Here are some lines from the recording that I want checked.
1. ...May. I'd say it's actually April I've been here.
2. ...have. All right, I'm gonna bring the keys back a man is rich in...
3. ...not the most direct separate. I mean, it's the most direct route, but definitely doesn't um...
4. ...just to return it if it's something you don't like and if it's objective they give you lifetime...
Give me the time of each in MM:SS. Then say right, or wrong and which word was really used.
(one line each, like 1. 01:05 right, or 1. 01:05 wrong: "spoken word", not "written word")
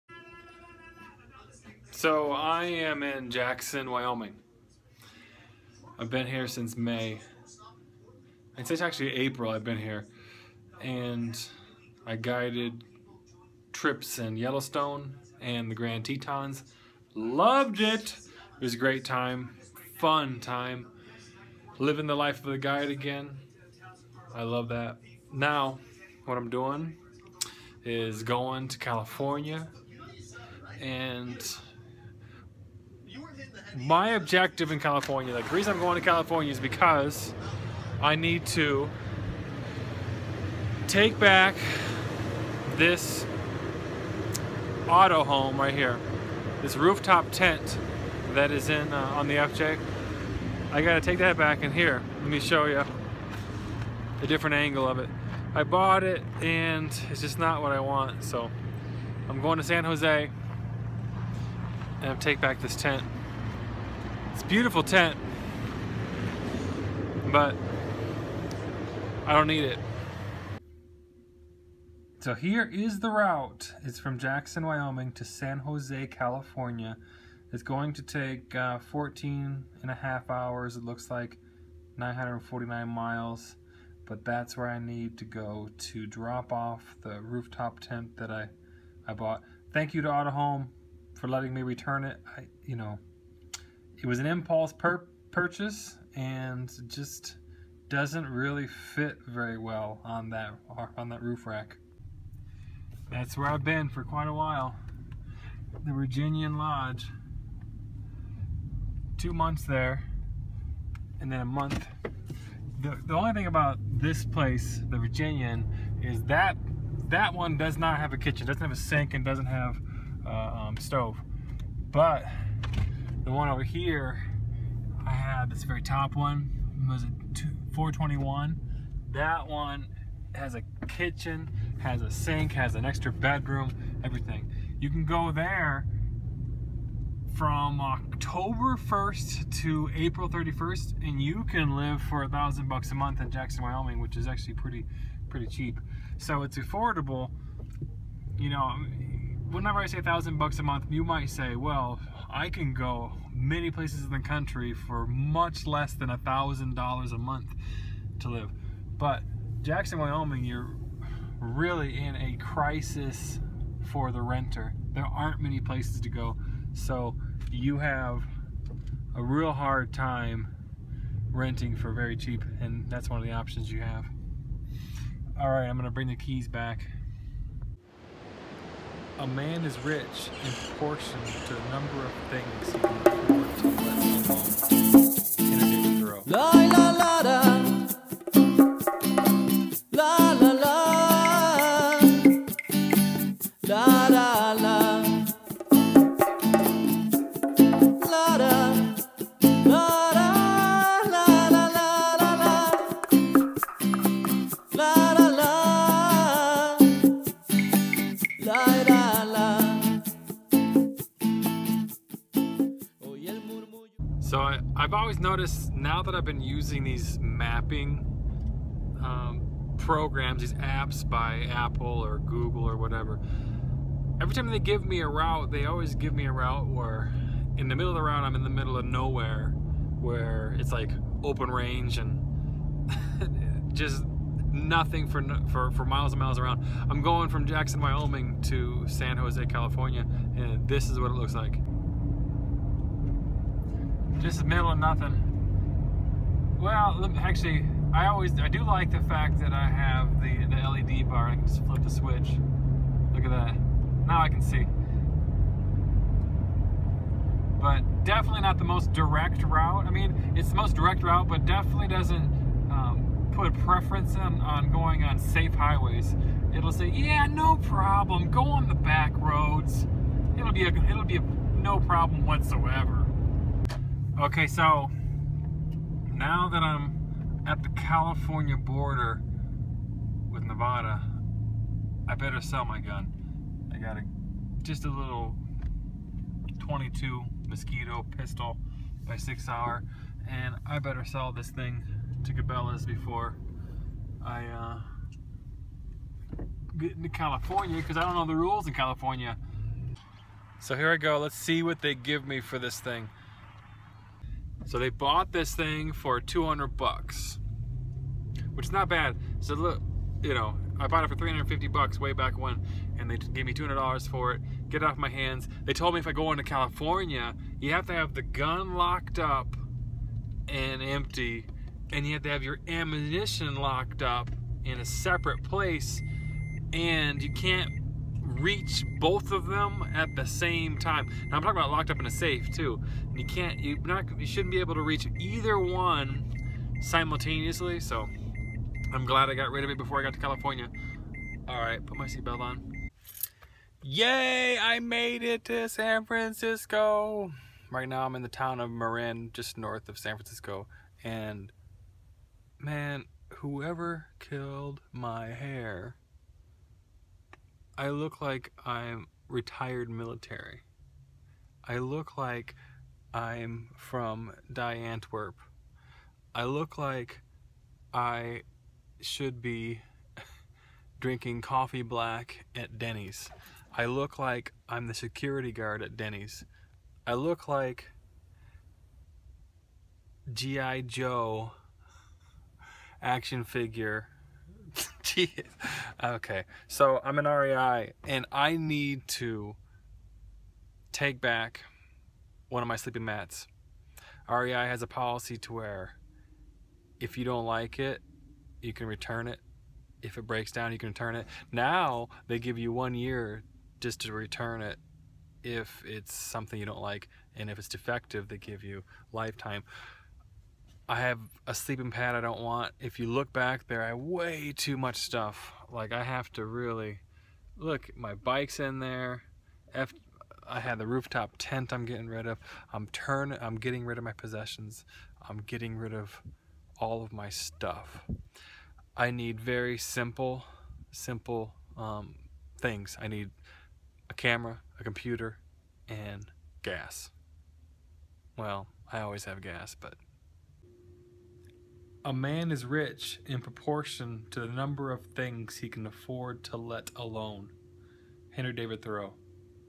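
1. 00:06 right
2. 02:53 right
3. 04:18 wrong: "route", not "separate"
4. 06:43 wrong: "defective", not "objective".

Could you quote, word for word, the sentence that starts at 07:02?
I'm turn, I'm getting rid of my possessions.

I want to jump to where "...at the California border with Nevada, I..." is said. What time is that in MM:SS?
04:37.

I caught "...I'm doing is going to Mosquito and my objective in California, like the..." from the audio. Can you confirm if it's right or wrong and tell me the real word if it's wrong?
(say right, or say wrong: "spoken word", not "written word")
wrong: "California", not "Mosquito".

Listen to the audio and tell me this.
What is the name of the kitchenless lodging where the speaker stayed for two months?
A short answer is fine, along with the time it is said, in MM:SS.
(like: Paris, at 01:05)
The Virginian Lodge, at 01:45.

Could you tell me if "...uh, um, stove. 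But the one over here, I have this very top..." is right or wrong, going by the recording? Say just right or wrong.
right.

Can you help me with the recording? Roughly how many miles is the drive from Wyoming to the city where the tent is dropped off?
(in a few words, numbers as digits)
949.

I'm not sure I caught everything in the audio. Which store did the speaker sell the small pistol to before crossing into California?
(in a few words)
Cabela's.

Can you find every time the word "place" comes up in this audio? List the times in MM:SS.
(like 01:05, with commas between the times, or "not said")
01:54, 02:33, 02:45, 05:25.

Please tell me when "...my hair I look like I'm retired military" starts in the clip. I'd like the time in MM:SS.
05:54.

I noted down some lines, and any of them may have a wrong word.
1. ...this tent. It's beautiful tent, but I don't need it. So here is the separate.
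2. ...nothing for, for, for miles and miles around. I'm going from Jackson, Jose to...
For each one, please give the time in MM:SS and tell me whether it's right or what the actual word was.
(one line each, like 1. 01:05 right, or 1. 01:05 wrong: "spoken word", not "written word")
1. 01:02 wrong: "route", not "separate"
2. 03:54 wrong: "Wyoming", not "Jose".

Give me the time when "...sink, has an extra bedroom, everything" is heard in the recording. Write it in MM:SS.
02:12.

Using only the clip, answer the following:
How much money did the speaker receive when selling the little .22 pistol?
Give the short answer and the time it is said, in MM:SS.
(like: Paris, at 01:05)
$200, at 05:06.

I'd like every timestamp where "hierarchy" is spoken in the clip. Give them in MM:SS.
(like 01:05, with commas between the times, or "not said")
not said.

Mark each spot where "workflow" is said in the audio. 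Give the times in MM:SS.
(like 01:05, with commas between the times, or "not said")
not said.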